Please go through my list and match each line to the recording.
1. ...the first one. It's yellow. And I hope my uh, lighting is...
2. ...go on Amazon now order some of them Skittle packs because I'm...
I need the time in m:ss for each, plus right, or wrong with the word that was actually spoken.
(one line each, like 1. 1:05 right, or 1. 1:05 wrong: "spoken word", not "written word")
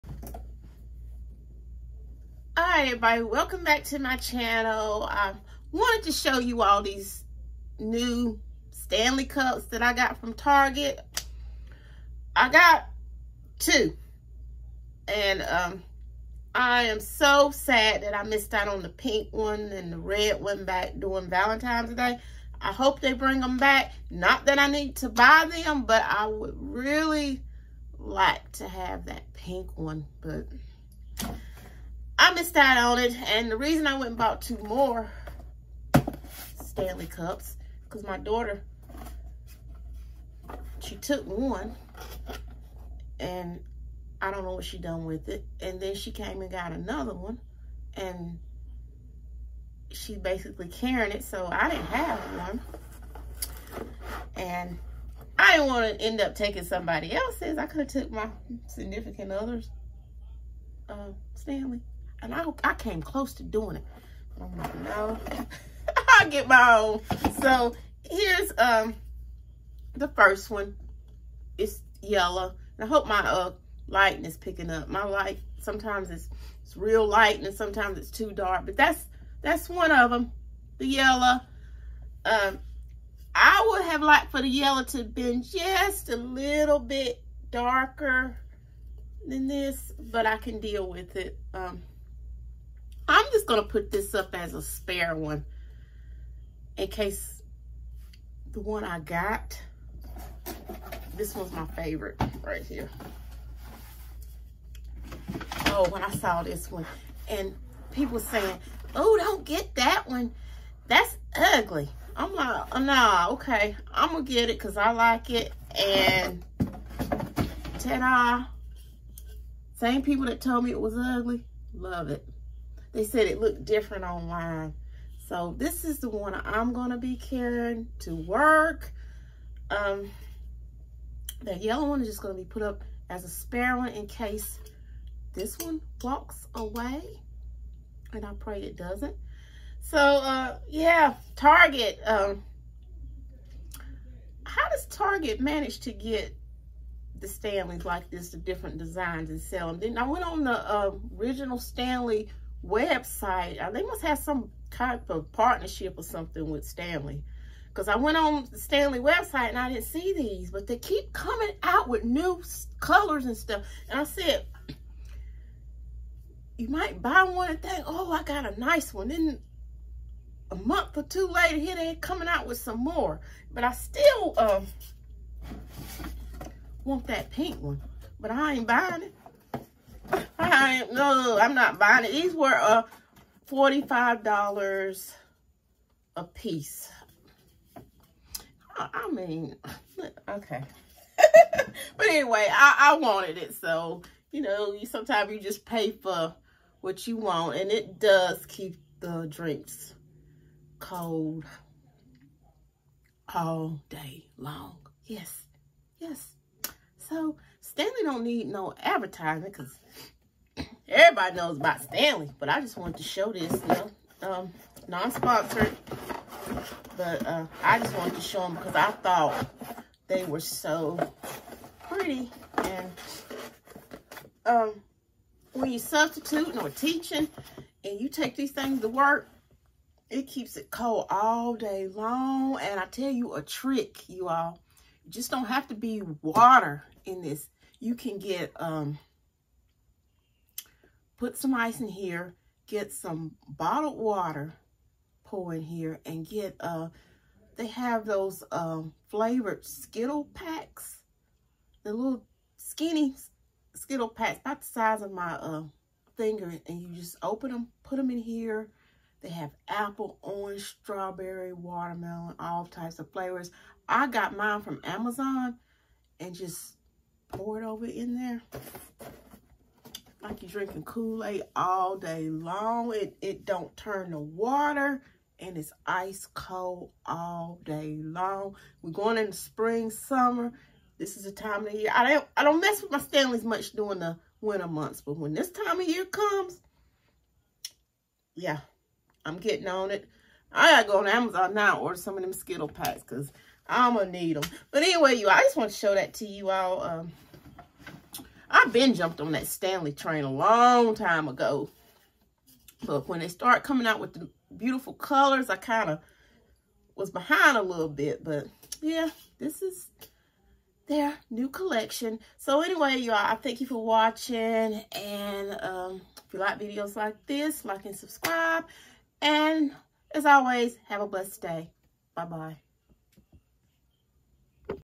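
1. 1:09 right
2. 4:50 right.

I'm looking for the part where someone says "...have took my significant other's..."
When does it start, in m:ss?
0:57.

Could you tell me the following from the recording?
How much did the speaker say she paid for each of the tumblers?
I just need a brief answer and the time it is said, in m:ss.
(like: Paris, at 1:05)
$45, at 3:03.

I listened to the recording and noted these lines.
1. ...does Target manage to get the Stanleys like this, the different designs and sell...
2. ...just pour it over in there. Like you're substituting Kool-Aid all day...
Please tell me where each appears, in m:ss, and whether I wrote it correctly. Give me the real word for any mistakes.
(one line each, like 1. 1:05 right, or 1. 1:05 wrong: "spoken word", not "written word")
1. 2:24 right
2. 4:26 wrong: "drinking", not "substituting".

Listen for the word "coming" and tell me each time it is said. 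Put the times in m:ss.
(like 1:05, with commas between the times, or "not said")
2:41, 2:51, 5:03.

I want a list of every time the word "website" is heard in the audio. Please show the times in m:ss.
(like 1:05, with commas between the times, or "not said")
2:32, 2:38.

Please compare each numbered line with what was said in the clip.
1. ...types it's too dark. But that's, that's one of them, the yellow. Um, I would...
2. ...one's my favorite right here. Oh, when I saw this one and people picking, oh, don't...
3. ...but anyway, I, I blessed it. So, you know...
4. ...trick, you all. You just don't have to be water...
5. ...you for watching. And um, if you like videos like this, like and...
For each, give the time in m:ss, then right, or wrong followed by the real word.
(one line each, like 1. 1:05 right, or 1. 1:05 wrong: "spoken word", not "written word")
1. 1:17 wrong: "sometimes", not "types"
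2. 1:41 wrong: "saying", not "picking"
3. 3:11 wrong: "wanted", not "blessed"
4. 3:53 right
5. 5:13 right.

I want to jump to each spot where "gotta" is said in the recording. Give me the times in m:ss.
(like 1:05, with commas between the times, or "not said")
4:50.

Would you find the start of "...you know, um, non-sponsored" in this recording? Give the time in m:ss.
3:33.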